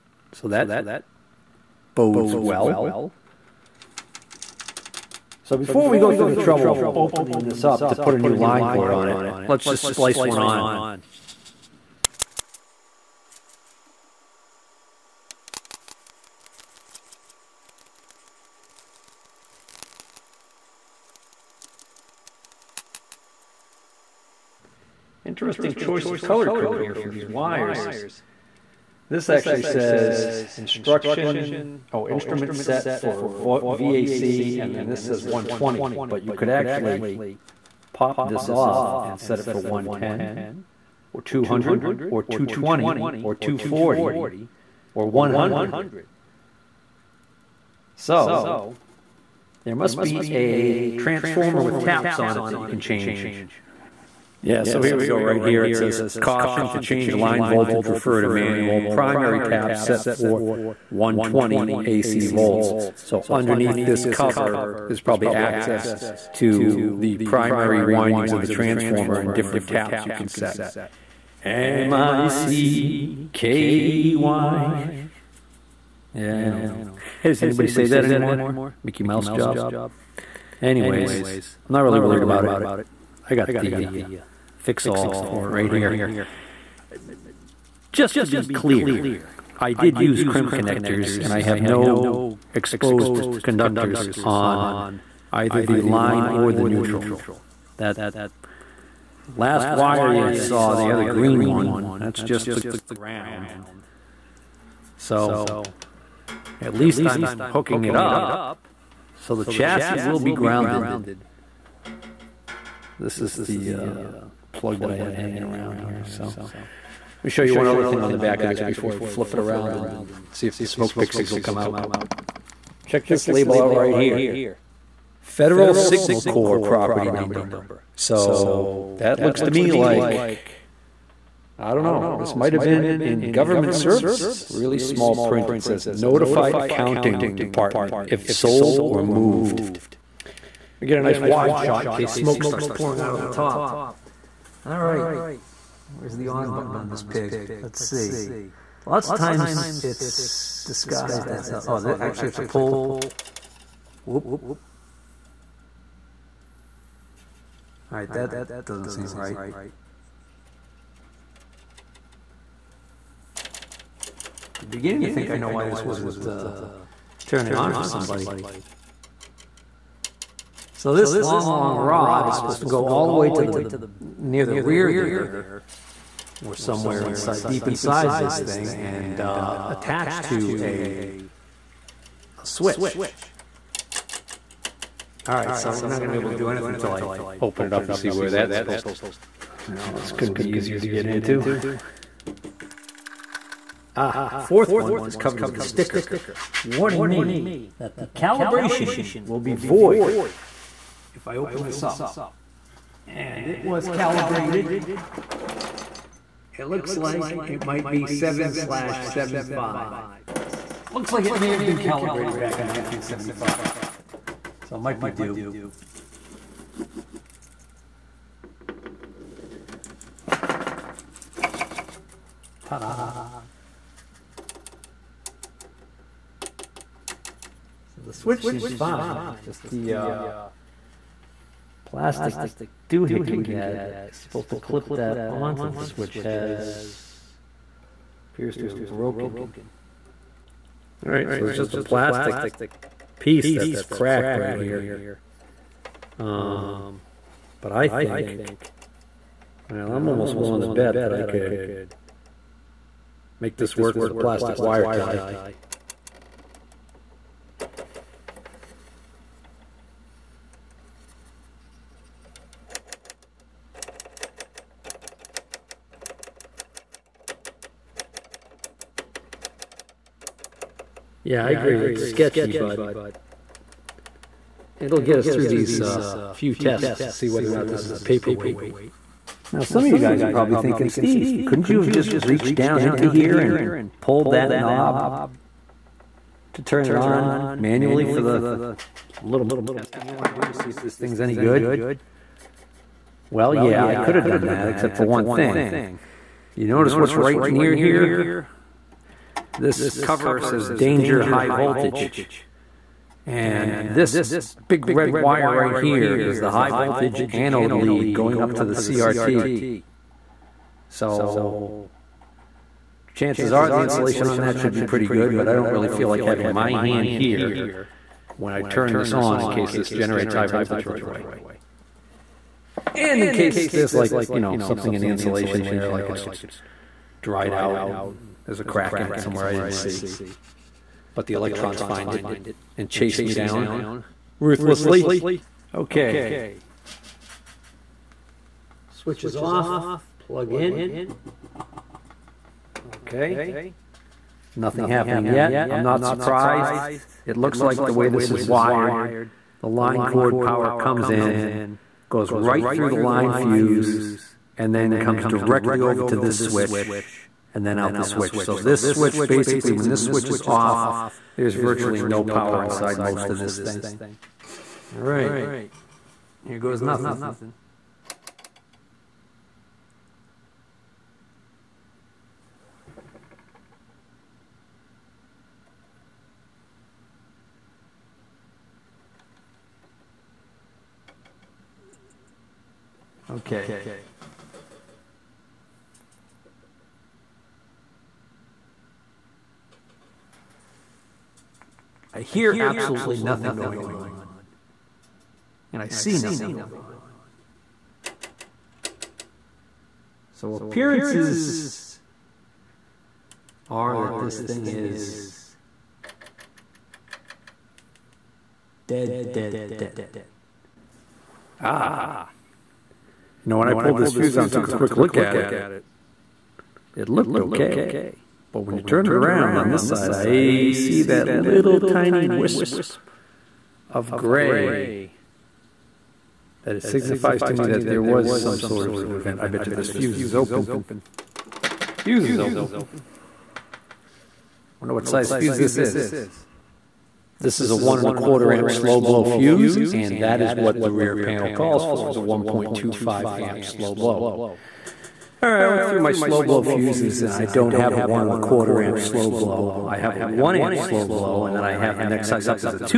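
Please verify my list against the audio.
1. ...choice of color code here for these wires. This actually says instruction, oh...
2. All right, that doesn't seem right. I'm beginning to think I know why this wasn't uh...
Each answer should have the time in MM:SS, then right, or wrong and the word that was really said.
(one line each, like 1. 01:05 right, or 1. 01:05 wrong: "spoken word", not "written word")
1. 00:25 right
2. 02:37 right.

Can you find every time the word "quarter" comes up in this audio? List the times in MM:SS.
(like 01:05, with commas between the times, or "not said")
07:18, 07:28.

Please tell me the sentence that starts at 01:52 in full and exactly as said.
This is the uh, plug that I had hanging around here.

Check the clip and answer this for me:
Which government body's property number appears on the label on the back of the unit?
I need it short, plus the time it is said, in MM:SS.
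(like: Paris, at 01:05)
Federal Signal Corps, at 02:05.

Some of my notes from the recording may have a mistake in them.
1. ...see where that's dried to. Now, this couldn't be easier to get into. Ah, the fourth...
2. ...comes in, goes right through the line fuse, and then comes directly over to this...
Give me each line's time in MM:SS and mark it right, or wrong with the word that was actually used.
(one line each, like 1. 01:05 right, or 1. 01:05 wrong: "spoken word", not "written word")
1. 03:07 wrong: "supposed", not "dried"
2. 05:50 right.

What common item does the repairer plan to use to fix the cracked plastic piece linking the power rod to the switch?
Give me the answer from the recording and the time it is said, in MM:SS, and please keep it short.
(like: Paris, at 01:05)
plastic wire tie, at 04:14.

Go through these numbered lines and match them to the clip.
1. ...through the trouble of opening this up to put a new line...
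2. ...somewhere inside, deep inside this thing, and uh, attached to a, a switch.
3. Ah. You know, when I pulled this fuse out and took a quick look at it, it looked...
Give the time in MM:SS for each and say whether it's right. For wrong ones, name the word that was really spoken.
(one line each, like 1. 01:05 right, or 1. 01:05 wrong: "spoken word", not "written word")
1. 00:06 right
2. 02:56 right
3. 06:51 right.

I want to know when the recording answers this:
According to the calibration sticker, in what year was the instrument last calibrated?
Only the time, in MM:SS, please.
03:32.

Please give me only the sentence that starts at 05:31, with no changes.
But the electrons find it and chase me down ruthlessly.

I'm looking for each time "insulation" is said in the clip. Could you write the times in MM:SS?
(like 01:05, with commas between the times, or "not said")
05:13, 05:25.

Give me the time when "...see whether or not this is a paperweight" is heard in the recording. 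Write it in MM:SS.
04:37.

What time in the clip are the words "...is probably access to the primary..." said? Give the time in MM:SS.
01:04.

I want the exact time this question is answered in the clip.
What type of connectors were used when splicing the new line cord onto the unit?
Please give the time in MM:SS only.
01:30.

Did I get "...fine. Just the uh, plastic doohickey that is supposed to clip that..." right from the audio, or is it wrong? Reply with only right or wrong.
right.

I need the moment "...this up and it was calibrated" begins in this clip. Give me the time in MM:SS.
03:21.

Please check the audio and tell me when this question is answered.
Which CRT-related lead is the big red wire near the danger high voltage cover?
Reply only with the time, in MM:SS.
05:06.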